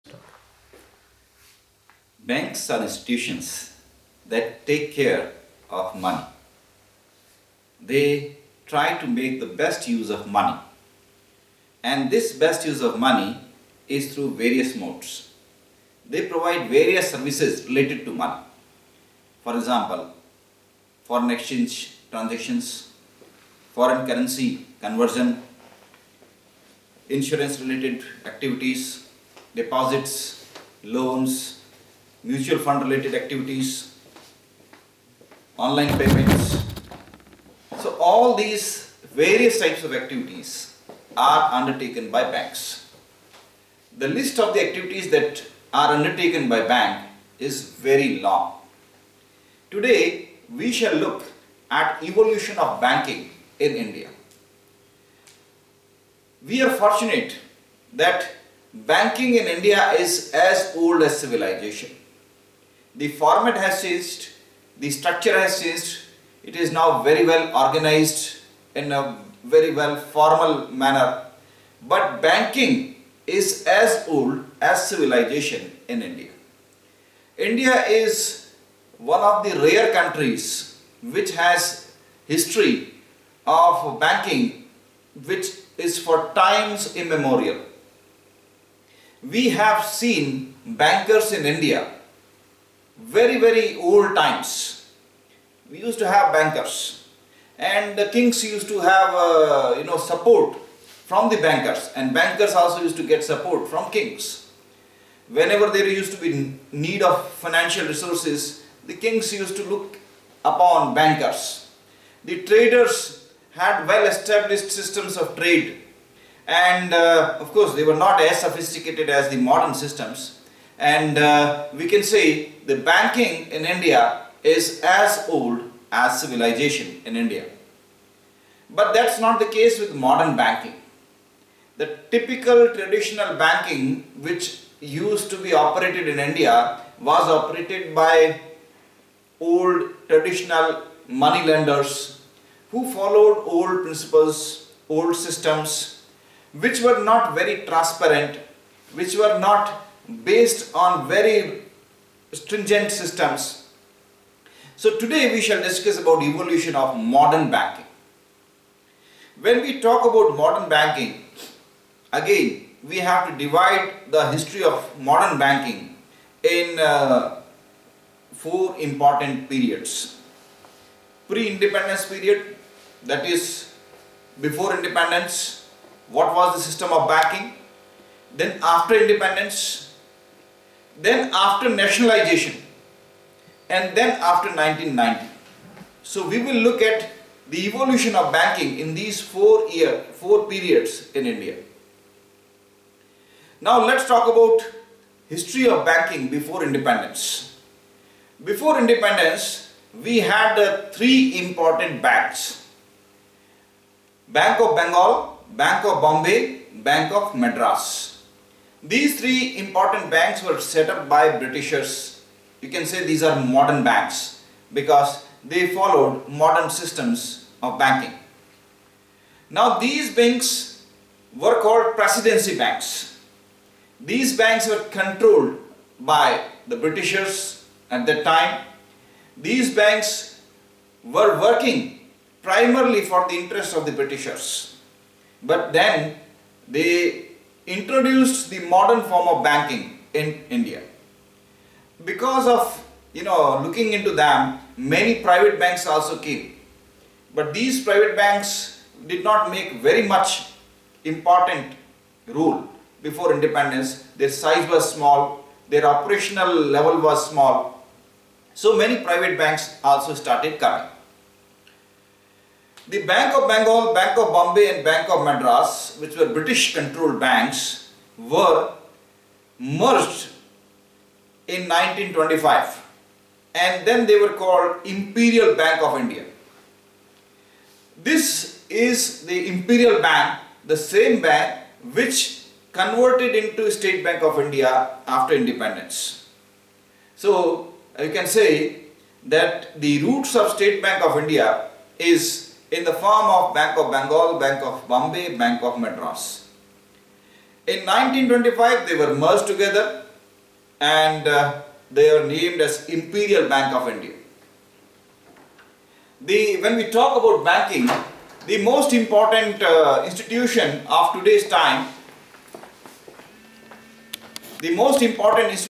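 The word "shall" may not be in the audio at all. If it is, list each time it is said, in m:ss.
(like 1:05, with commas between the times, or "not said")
0:50, 2:35.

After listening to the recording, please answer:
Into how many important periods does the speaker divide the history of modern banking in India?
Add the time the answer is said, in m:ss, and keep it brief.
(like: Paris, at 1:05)
4, at 2:48.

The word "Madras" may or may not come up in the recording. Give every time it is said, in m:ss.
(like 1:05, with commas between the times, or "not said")
3:27, 4:25, 4:55.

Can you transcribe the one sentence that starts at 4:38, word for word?
This is the Imperial Bank, the same bank which converted into State Bank of India after independence.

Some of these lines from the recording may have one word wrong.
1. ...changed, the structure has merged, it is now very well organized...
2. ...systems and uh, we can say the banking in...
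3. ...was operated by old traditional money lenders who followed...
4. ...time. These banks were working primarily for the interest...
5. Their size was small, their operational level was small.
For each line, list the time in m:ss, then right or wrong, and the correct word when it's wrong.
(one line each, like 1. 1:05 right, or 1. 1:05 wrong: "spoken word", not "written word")
1. 1:03 wrong: "changed", not "merged"
2. 1:59 right
3. 2:16 right
4. 3:48 right
5. 4:14 right.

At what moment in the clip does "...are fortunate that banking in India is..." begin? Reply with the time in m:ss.
0:56.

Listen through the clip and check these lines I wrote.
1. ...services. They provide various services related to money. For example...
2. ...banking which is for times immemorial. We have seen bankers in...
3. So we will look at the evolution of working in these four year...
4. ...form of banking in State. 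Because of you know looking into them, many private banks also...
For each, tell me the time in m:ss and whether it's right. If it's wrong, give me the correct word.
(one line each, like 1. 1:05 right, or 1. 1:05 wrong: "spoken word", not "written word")
1. 0:14 wrong: "modes", not "services"
2. 1:23 right
3. 3:06 wrong: "banking", not "working"
4. 3:59 wrong: "India", not "State".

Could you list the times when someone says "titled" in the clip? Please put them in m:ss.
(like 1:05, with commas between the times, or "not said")
not said.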